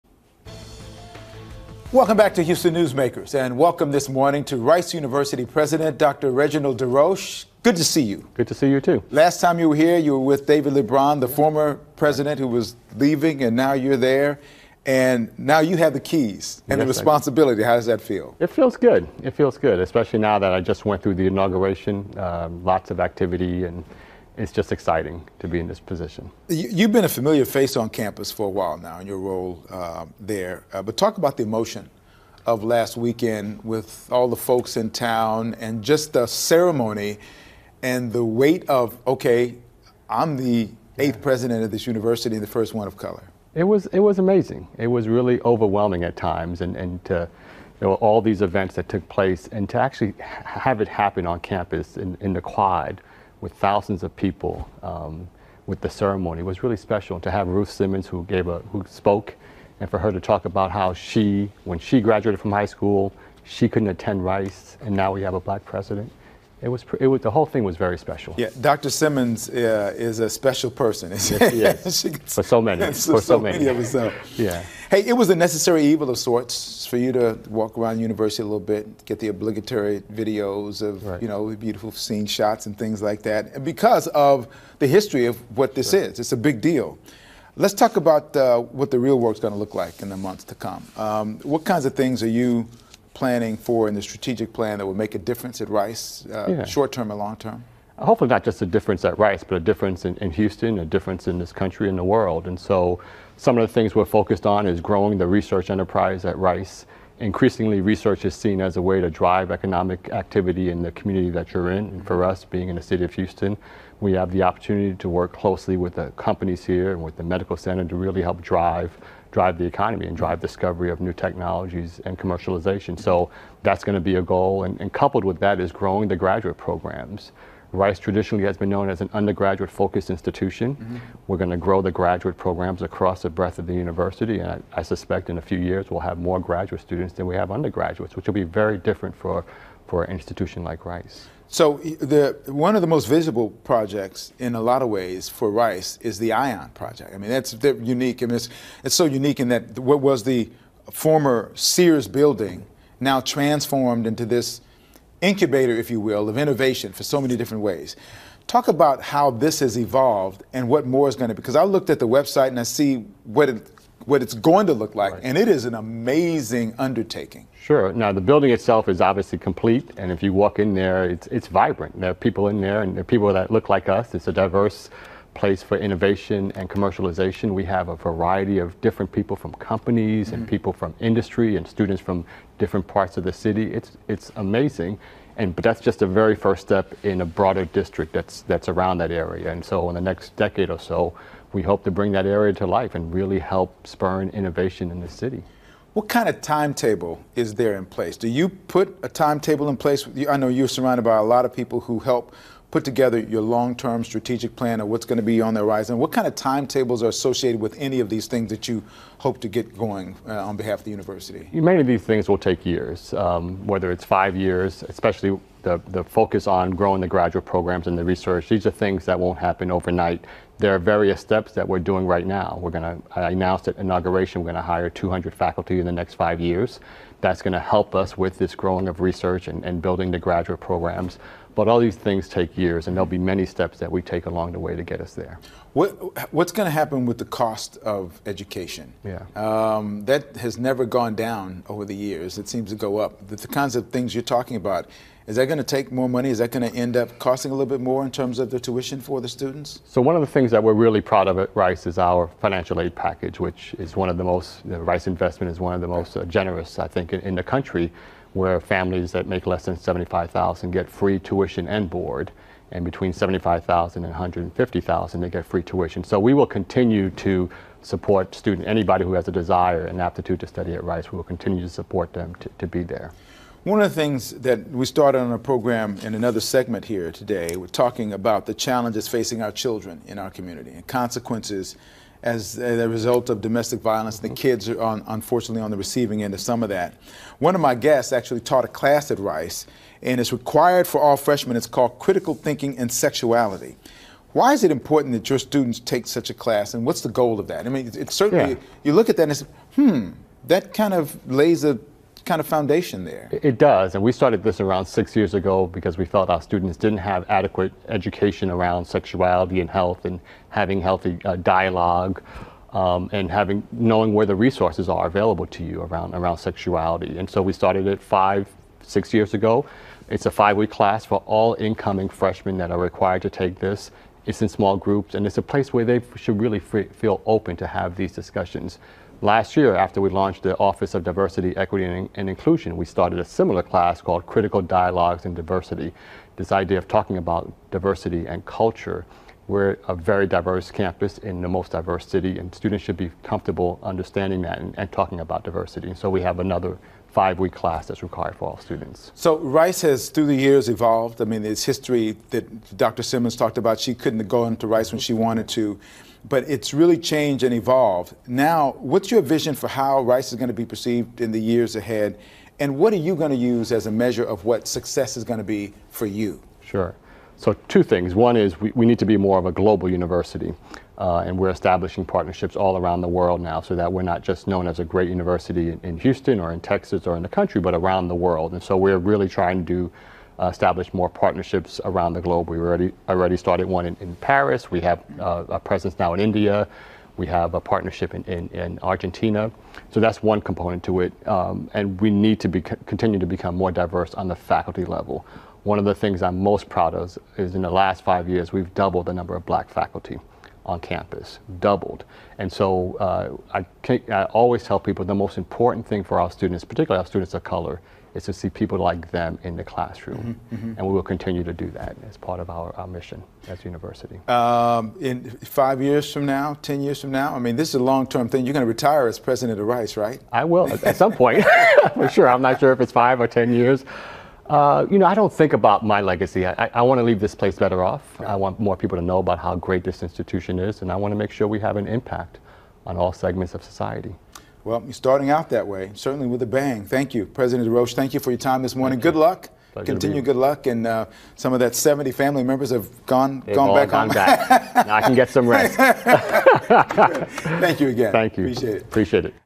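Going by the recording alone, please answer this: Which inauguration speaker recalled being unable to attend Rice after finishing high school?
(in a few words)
Ruth Simmons.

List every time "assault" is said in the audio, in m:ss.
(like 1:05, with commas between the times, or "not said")
not said.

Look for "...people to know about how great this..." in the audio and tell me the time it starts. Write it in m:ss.
7:08.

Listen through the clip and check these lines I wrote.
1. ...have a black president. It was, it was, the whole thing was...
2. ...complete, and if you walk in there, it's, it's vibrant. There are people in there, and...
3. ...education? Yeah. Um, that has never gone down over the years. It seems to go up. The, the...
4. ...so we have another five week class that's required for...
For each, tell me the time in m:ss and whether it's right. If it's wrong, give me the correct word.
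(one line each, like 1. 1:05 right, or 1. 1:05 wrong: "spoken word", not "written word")
1. 1:05 right
2. 2:49 right
3. 3:58 right
4. 5:45 right.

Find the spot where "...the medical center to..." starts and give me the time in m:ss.
1:57.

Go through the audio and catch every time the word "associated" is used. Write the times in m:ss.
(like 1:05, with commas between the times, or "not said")
3:27.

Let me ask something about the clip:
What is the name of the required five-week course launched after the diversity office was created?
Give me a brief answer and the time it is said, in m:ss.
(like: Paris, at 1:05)
Critical Dialogues in Diversity, at 5:34.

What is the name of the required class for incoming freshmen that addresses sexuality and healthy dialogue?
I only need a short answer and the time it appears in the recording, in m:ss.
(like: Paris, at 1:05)
Critical Thinking and Sexuality, at 4:51.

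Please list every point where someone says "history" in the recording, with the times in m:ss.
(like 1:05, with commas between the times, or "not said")
1:24, 5:51.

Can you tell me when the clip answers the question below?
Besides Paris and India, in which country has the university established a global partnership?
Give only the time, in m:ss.
6:28.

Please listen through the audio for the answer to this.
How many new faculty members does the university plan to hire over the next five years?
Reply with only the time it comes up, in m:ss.
3:44.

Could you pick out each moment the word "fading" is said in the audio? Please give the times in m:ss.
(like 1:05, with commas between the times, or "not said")
not said.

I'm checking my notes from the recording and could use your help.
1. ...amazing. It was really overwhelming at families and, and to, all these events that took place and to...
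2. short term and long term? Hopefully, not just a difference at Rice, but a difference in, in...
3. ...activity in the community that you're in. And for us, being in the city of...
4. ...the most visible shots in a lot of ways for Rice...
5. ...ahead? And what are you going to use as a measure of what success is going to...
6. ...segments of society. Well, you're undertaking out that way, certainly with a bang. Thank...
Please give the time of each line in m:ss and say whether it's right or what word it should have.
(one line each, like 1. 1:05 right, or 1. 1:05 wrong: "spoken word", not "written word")
1. 0:44 wrong: "times", not "families"
2. 1:36 right
3. 1:50 right
4. 2:22 wrong: "projects", not "shots"
5. 6:01 right
6. 7:13 wrong: "starting", not "undertaking".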